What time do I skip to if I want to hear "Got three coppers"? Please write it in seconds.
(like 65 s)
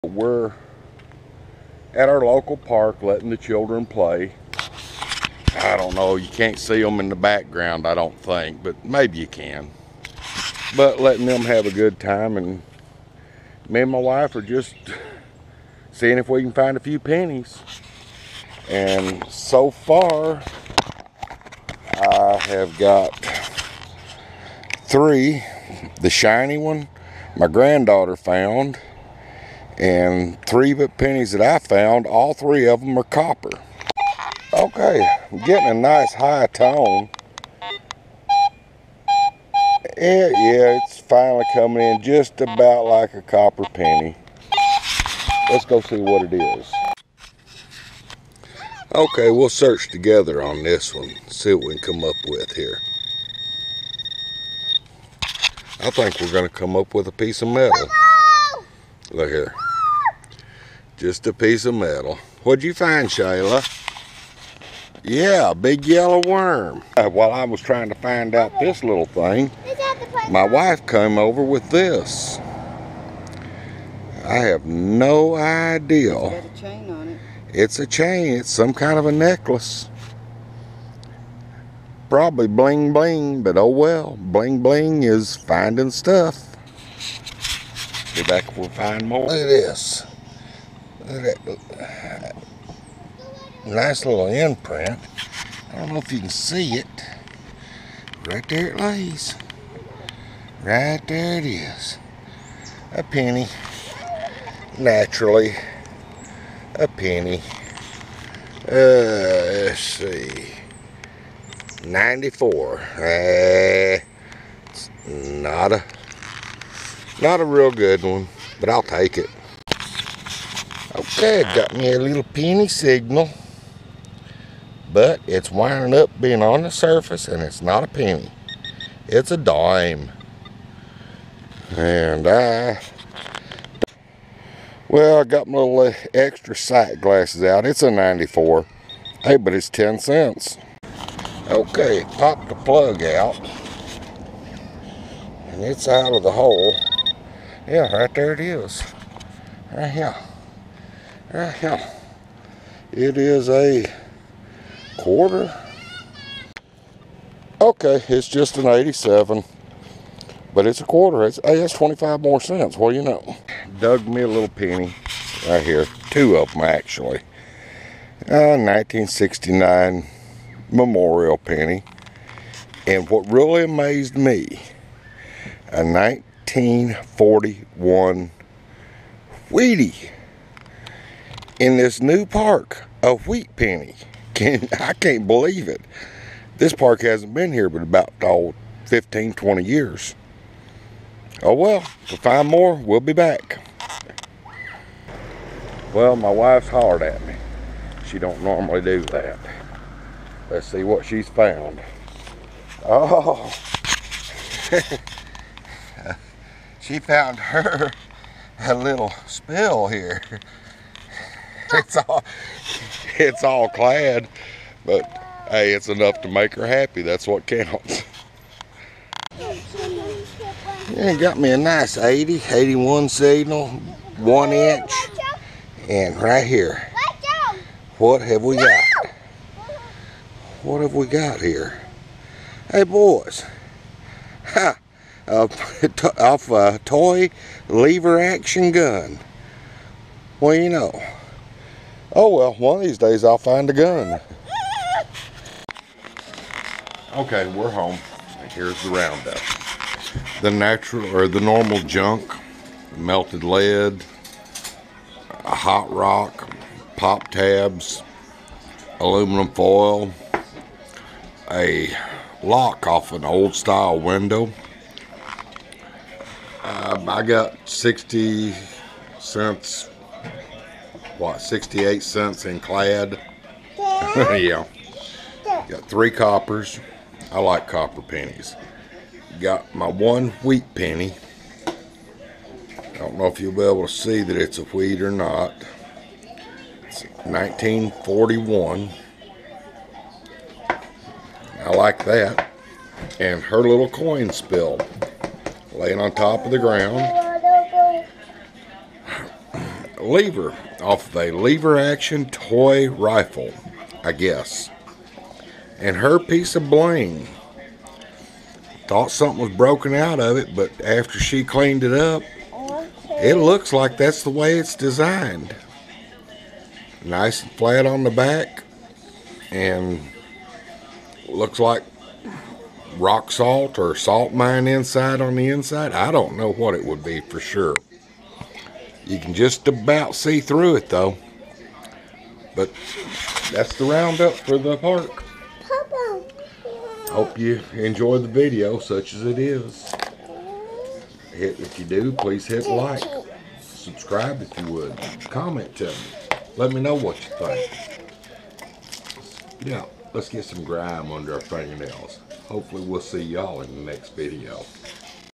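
275 s.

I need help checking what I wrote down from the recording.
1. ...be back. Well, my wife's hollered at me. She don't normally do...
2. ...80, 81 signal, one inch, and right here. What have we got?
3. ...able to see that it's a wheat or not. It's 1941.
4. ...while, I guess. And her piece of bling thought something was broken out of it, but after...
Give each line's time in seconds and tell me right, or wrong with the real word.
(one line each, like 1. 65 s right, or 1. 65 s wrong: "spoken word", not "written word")
1. 192 s right
2. 221 s right
3. 283 s right
4. 302 s wrong: "rifle", not "while".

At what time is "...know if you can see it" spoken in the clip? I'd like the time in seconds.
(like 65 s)
95 s.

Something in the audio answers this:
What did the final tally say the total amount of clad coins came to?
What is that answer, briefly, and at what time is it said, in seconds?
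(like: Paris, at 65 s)
68 cents, at 271 s.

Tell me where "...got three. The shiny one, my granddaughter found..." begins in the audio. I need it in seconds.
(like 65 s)
22 s.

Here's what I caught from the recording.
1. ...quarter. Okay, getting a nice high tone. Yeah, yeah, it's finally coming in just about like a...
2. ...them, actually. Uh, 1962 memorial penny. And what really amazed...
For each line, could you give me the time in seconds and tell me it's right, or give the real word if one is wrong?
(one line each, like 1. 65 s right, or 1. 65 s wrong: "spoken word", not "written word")
1. 33 s wrong: "copper", not "quarter"
2. 166 s wrong: "1969", not "1962".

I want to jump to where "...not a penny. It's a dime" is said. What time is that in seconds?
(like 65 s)
127 s.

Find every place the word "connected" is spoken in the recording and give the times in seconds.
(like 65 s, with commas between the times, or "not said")
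not said.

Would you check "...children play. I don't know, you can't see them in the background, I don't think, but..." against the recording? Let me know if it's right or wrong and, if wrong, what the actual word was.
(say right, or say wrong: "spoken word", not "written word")
right.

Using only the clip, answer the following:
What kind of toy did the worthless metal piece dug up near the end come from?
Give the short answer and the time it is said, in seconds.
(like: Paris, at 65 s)
Toy lever action gun, at 236 s.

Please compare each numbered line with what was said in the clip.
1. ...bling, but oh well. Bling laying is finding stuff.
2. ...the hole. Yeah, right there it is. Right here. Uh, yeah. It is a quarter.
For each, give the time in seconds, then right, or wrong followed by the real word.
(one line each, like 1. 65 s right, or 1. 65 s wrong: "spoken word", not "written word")
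1. 82 s wrong: "bling", not "laying"
2. 146 s right.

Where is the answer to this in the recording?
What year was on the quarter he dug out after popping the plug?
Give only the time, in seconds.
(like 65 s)
158 s.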